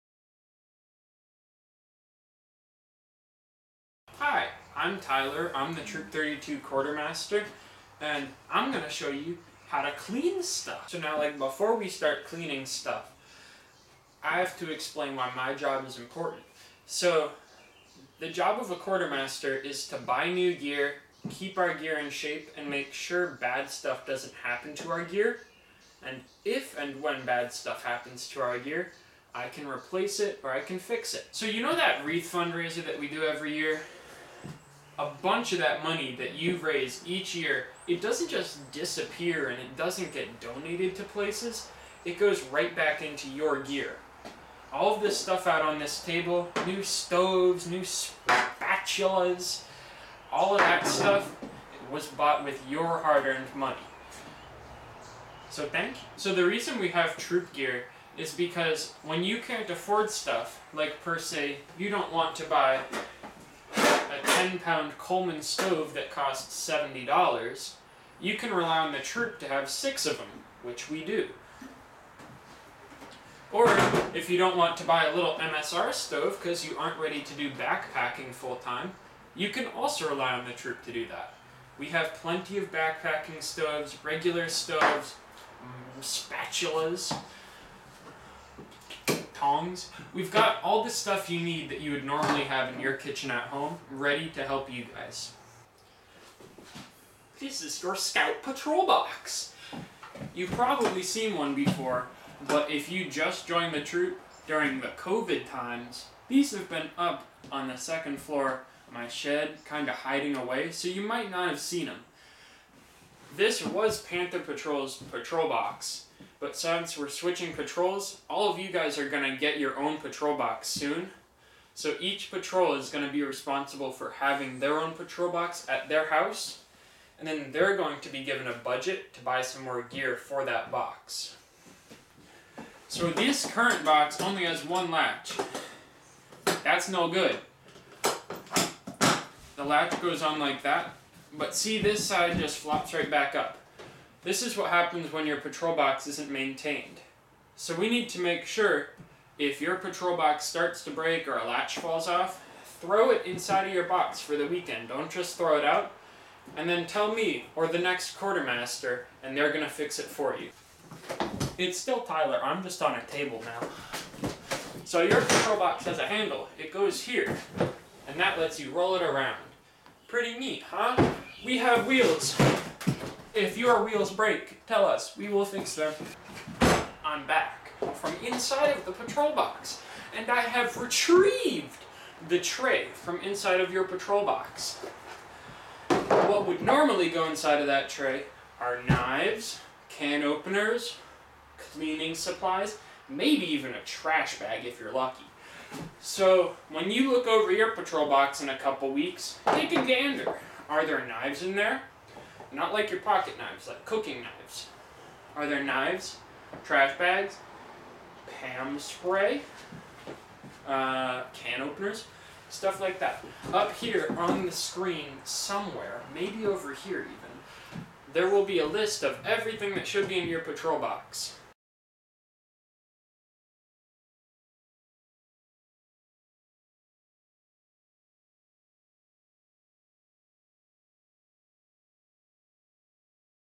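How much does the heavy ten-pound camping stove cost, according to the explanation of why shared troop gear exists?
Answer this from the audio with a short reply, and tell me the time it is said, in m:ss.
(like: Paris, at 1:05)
$70, at 1:06.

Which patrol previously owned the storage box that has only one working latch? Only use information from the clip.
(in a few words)
Panther Patrol.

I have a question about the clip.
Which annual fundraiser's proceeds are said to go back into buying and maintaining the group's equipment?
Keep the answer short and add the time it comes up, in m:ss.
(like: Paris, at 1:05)
Wreath fundraiser, at 0:32.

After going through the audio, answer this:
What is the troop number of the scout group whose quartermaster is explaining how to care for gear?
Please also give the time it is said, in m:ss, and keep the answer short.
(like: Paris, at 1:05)
32, at 0:05.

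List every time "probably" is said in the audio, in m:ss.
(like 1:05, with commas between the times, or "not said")
1:40.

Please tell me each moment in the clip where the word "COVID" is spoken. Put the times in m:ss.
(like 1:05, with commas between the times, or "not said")
1:44.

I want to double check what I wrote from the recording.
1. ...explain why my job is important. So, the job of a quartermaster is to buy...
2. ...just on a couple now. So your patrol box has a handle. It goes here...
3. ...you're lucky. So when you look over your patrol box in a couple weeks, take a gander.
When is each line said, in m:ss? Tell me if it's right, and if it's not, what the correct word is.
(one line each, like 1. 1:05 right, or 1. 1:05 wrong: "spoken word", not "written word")
1. 0:14 right
2. 2:42 wrong: "table", not "couple"
3. 3:14 right.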